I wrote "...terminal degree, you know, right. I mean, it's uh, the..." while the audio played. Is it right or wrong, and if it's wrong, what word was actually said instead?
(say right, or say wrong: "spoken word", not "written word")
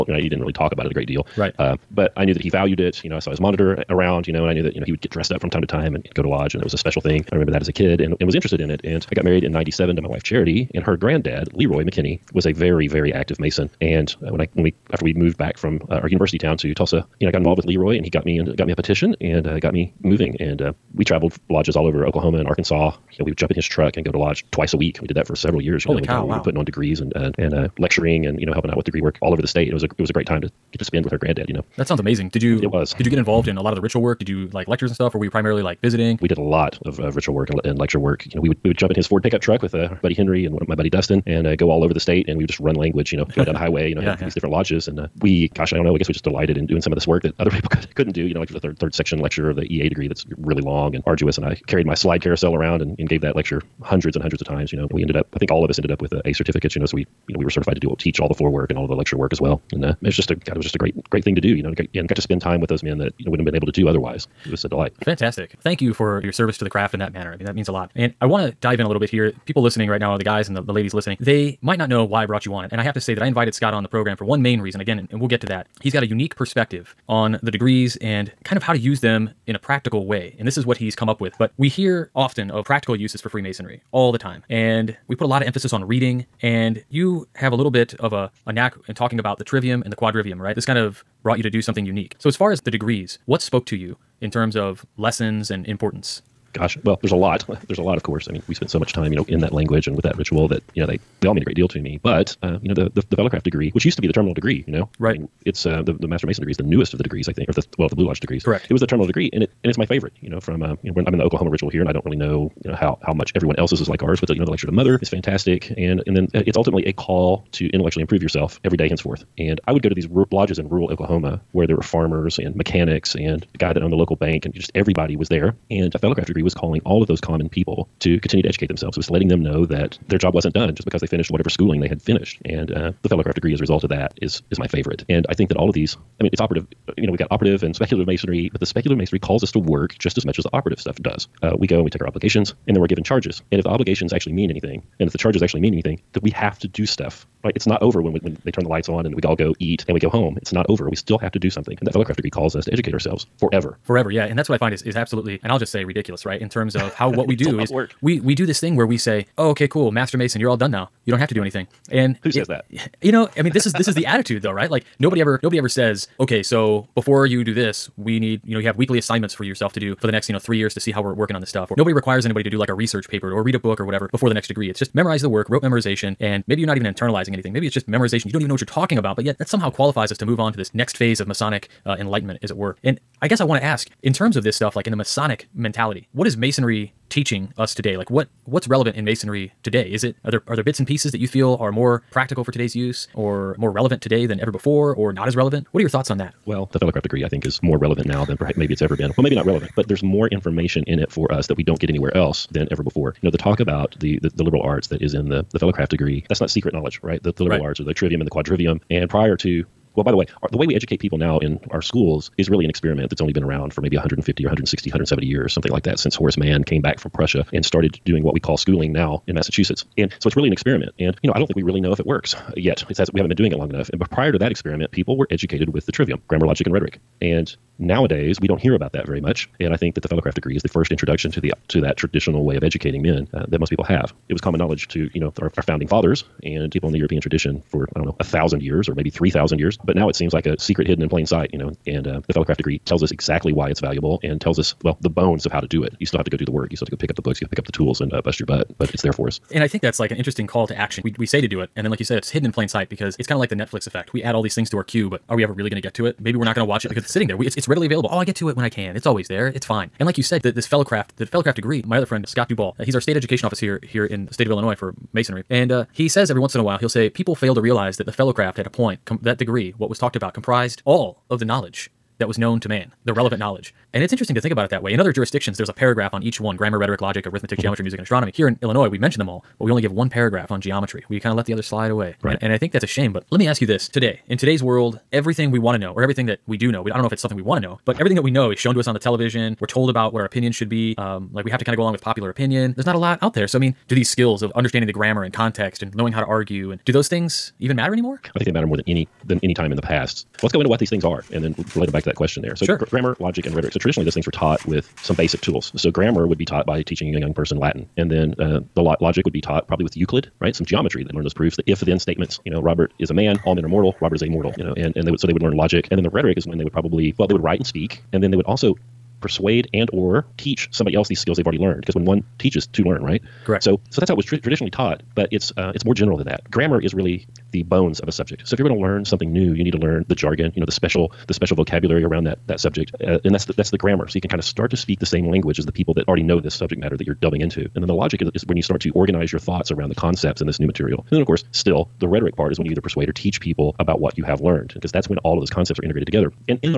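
right.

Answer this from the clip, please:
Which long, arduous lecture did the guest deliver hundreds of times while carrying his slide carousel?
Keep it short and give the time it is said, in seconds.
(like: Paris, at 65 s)
Third section lecture of the EA degree, at 48 s.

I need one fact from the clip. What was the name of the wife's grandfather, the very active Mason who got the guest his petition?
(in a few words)
Leroy McKinney.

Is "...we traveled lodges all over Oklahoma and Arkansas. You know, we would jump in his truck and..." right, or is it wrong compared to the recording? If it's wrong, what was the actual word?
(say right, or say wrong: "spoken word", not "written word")
right.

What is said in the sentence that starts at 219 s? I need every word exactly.
And so it's really an experiment.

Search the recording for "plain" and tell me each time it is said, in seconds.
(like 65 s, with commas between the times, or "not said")
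241 s, 252 s.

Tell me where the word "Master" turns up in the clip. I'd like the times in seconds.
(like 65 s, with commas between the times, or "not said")
106 s, 159 s.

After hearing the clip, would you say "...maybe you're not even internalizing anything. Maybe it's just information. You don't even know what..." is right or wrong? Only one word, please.
wrong.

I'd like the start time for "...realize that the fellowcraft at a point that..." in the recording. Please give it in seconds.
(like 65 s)
267 s.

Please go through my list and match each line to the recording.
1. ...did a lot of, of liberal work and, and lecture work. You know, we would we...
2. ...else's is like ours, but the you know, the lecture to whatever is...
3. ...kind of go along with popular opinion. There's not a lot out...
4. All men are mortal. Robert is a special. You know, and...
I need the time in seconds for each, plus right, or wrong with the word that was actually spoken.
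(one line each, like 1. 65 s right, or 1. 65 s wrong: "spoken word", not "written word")
1. 36 s wrong: "ritual", not "liberal"
2. 113 s wrong: "mother", not "whatever"
3. 291 s right
4. 313 s wrong: "mortal", not "special".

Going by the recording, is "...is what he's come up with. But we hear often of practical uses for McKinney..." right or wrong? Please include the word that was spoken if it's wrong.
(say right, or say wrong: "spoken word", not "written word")
wrong: "Freemasonry", not "McKinney".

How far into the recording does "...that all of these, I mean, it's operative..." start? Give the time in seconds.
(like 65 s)
135 s.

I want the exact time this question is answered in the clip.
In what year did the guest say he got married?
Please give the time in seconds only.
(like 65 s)
9 s.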